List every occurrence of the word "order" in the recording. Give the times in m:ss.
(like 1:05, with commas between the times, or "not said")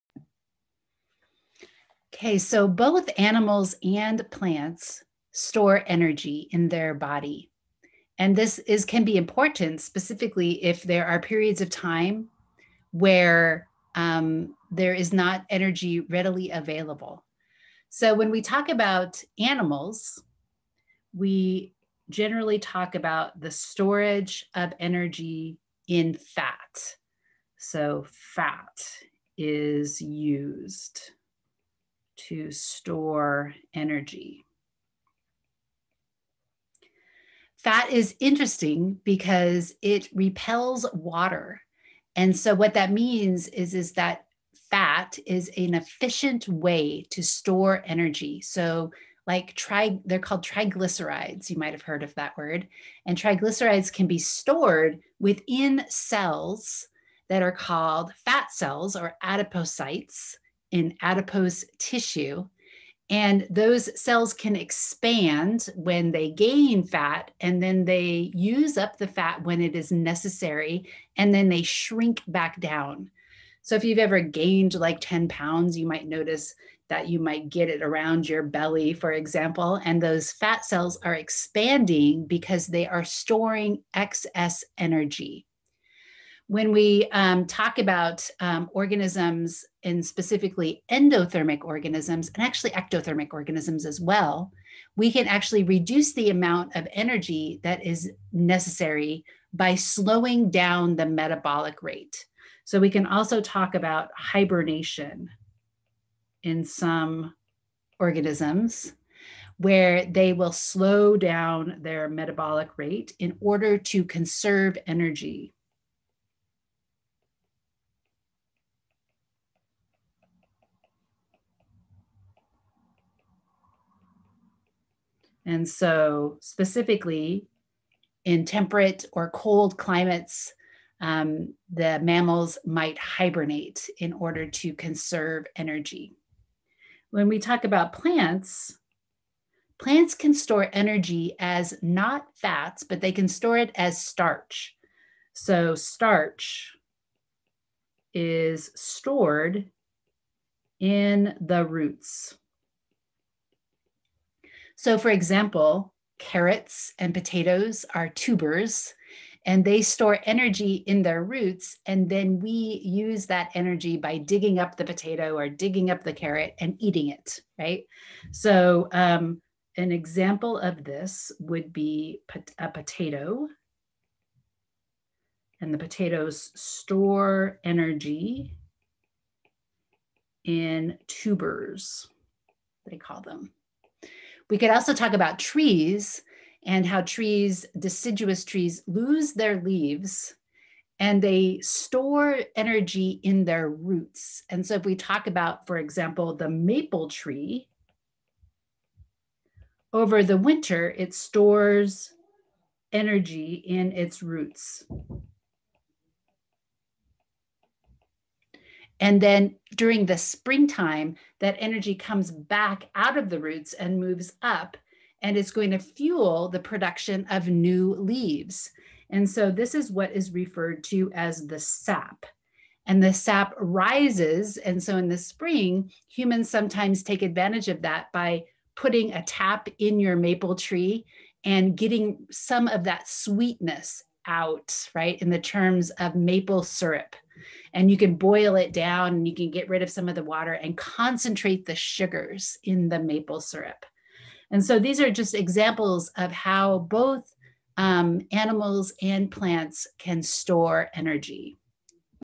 1:53, 2:14.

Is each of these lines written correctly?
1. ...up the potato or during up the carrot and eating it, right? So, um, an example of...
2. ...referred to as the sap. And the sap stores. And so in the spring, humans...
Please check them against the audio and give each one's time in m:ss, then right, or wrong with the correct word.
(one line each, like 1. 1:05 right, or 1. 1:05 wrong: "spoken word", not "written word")
1. 2:44 wrong: "digging", not "during"
2. 3:40 wrong: "rises", not "stores".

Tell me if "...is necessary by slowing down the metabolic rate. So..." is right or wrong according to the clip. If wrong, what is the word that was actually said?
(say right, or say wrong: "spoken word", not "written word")
right.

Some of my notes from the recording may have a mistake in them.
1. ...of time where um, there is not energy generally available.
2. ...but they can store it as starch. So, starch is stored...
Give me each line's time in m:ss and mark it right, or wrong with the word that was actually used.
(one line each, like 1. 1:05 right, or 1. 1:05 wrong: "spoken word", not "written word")
1. 0:11 wrong: "readily", not "generally"
2. 2:22 right.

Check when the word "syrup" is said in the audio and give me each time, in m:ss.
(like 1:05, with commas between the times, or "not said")
3:56, 4:03.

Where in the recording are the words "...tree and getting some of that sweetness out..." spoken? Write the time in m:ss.
3:50.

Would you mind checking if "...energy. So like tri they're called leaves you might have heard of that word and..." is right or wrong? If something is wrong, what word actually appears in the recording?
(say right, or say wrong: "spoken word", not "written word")
wrong: "triglycerides", not "leaves".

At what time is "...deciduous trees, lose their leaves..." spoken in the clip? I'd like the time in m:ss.
3:07.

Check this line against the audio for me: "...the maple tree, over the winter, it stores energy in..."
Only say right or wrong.
right.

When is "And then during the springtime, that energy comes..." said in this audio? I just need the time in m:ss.
3:29.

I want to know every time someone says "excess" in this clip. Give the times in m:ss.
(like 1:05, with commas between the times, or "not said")
1:23.